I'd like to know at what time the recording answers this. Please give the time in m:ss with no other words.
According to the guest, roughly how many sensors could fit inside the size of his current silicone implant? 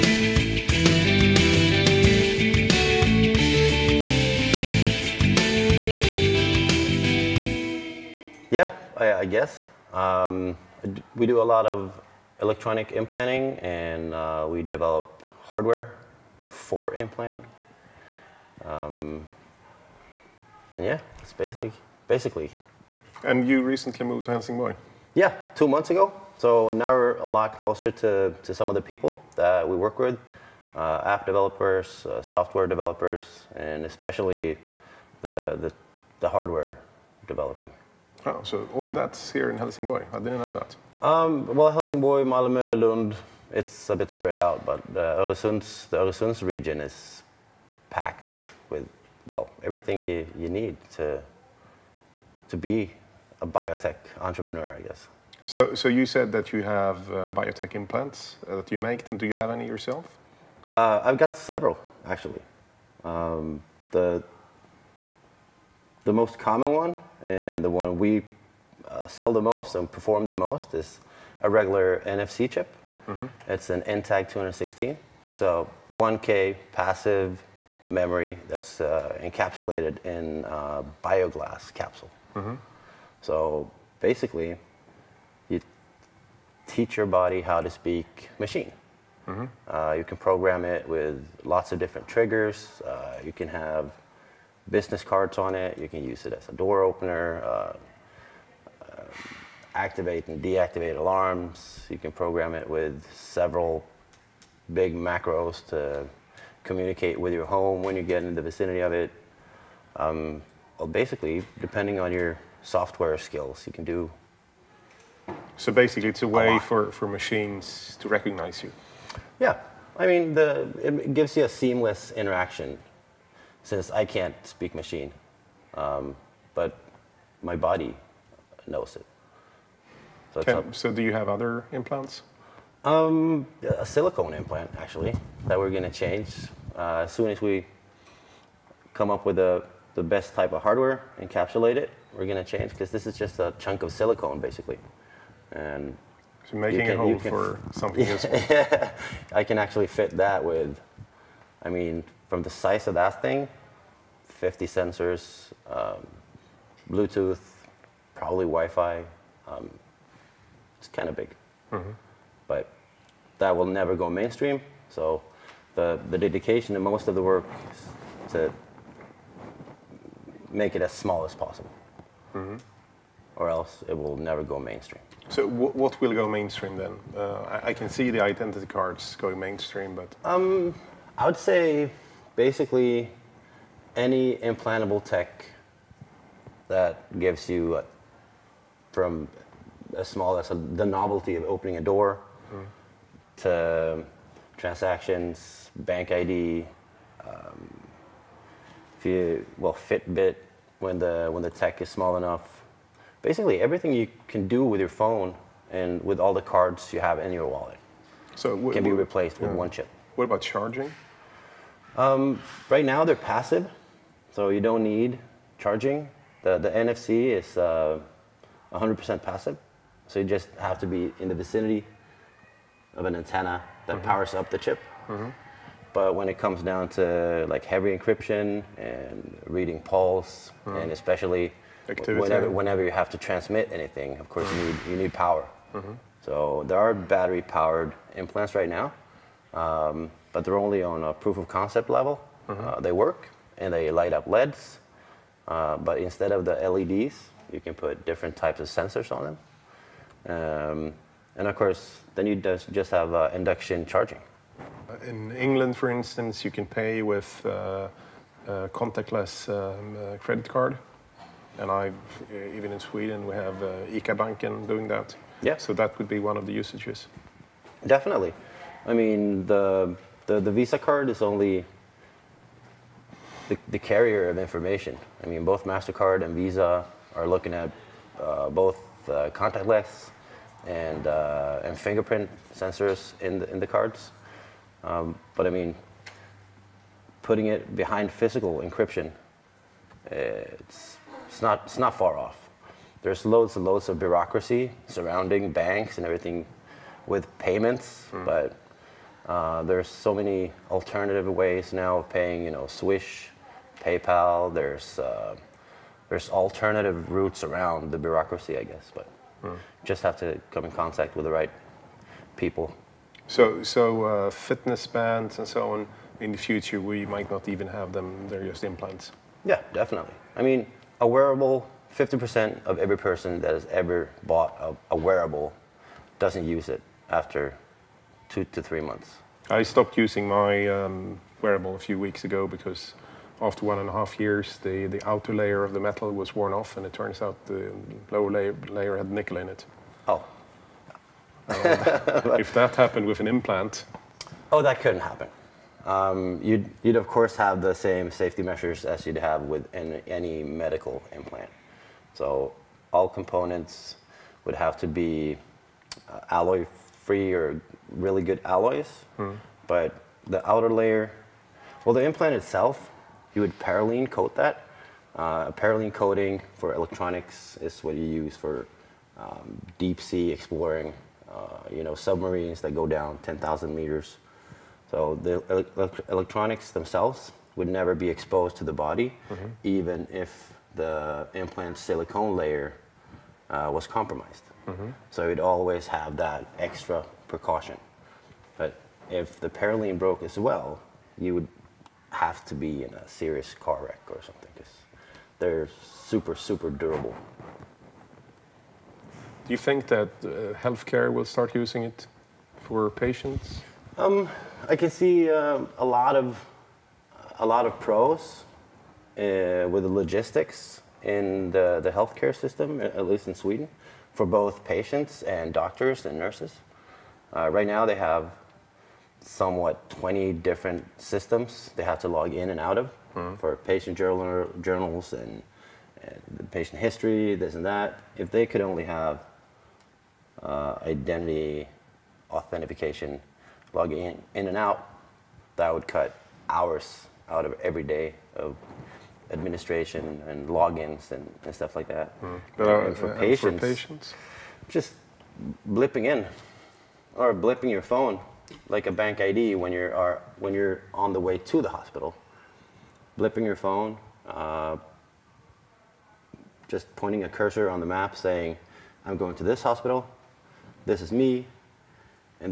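2:34.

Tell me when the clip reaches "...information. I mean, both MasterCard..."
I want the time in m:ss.
4:34.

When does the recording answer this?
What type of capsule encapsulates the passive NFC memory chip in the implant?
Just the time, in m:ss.
1:21.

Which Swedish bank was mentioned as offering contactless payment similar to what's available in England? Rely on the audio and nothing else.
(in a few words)
ICA Banken.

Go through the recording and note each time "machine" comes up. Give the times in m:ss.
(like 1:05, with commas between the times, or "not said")
1:28, 1:57, 2:04.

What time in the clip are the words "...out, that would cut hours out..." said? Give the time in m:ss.
7:14.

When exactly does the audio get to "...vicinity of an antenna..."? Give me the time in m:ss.
3:41.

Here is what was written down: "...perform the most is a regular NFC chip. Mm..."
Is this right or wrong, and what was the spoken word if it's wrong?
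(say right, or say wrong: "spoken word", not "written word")
right.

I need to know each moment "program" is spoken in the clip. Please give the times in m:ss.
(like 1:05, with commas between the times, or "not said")
1:30, 1:42.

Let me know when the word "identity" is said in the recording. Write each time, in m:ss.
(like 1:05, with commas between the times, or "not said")
2:58, 7:10.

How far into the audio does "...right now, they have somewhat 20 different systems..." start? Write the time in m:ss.
6:57.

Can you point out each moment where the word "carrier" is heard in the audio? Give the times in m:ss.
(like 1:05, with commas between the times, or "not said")
4:33.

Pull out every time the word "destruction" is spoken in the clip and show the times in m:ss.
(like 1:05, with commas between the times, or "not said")
not said.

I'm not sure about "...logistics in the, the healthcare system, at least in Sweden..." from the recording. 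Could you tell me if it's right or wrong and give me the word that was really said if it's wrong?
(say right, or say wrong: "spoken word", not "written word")
right.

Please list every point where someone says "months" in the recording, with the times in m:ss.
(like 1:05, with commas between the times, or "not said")
0:25, 5:28.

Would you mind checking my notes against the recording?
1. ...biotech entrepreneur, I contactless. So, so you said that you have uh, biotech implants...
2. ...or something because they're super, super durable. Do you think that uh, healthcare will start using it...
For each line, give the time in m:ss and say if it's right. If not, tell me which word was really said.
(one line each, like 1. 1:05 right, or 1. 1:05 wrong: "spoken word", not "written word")
1. 0:53 wrong: "guess", not "contactless"
2. 6:34 right.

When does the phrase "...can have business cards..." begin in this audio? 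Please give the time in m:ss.
1:33.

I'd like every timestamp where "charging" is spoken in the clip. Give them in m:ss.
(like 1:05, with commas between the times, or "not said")
3:30, 3:35, 4:13.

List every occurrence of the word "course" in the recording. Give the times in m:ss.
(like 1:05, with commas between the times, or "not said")
3:54, 4:11, 5:47.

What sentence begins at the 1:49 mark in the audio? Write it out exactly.
Um, well, basically, depending on your software skills.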